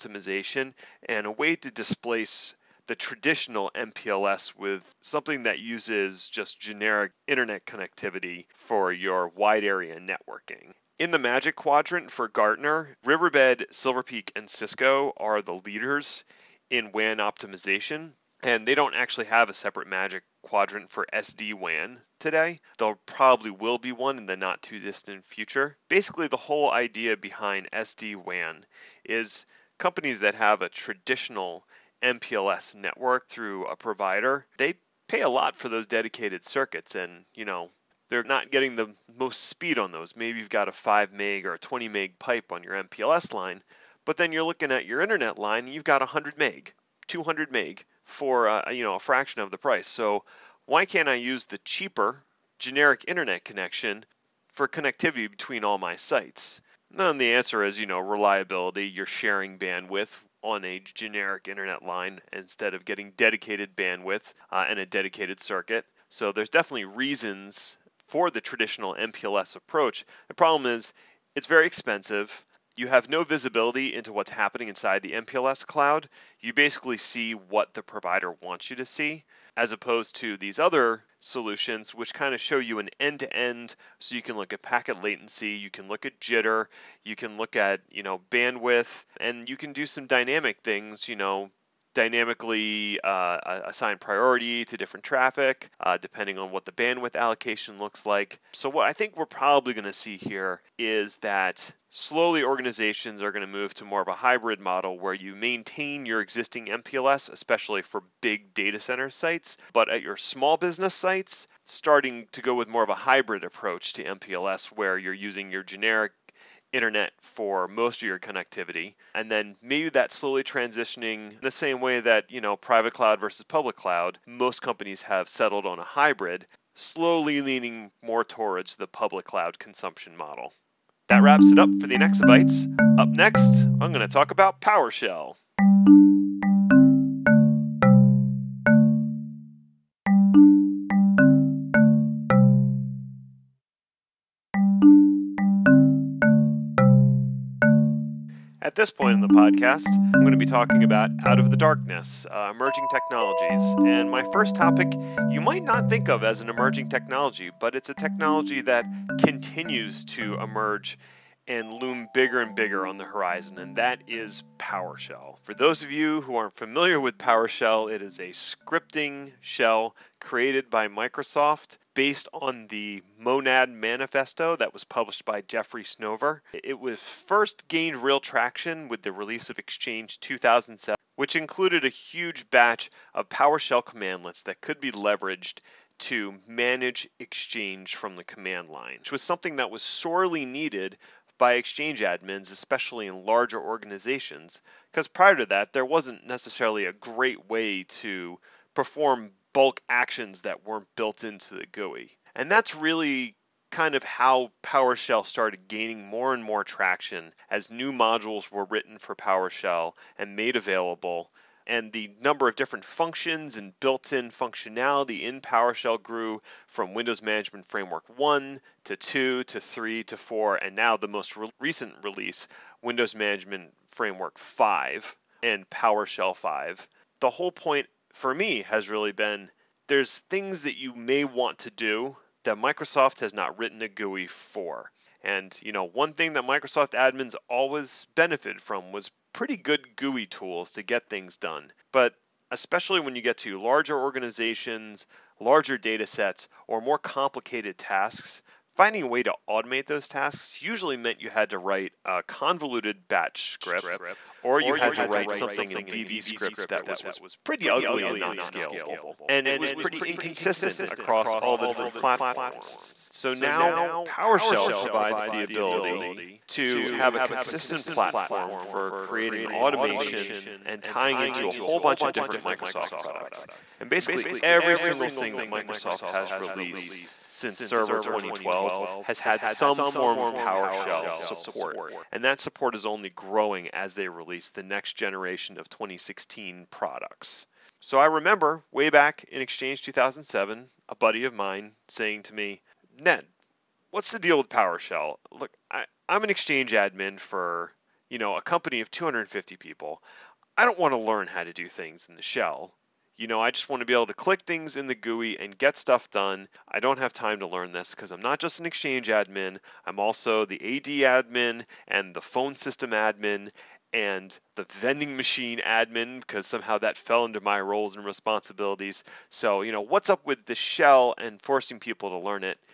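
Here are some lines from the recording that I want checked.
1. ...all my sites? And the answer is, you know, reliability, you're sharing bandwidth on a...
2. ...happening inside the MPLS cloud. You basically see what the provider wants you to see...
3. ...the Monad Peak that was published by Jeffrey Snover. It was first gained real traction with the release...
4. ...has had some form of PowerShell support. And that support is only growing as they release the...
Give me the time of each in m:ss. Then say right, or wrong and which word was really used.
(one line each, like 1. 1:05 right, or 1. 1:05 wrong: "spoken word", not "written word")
1. 0:55 right
2. 1:14 right
3. 2:52 wrong: "Manifesto", not "Peak"
4. 4:39 right.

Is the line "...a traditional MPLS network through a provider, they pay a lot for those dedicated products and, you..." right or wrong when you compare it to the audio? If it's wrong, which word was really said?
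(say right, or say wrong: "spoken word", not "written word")
wrong: "circuits", not "products".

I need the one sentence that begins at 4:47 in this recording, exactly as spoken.
So I remember way back in Exchange 2007, a buddy of mine saying to me, Ned, what's the deal with PowerShell?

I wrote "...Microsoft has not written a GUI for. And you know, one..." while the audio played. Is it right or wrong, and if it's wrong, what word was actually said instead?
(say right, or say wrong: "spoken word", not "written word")
right.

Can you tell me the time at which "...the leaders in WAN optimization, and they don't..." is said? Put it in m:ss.
0:15.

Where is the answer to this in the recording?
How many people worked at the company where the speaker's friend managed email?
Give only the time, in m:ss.
4:58.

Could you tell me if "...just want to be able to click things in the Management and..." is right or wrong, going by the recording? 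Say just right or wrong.
wrong.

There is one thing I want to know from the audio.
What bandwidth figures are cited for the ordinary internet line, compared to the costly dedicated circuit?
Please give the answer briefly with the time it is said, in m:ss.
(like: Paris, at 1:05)
100 meg, 200 meg, at 0:46.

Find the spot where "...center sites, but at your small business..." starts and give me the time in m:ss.
1:48.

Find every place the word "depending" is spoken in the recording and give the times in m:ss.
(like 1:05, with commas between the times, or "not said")
1:35.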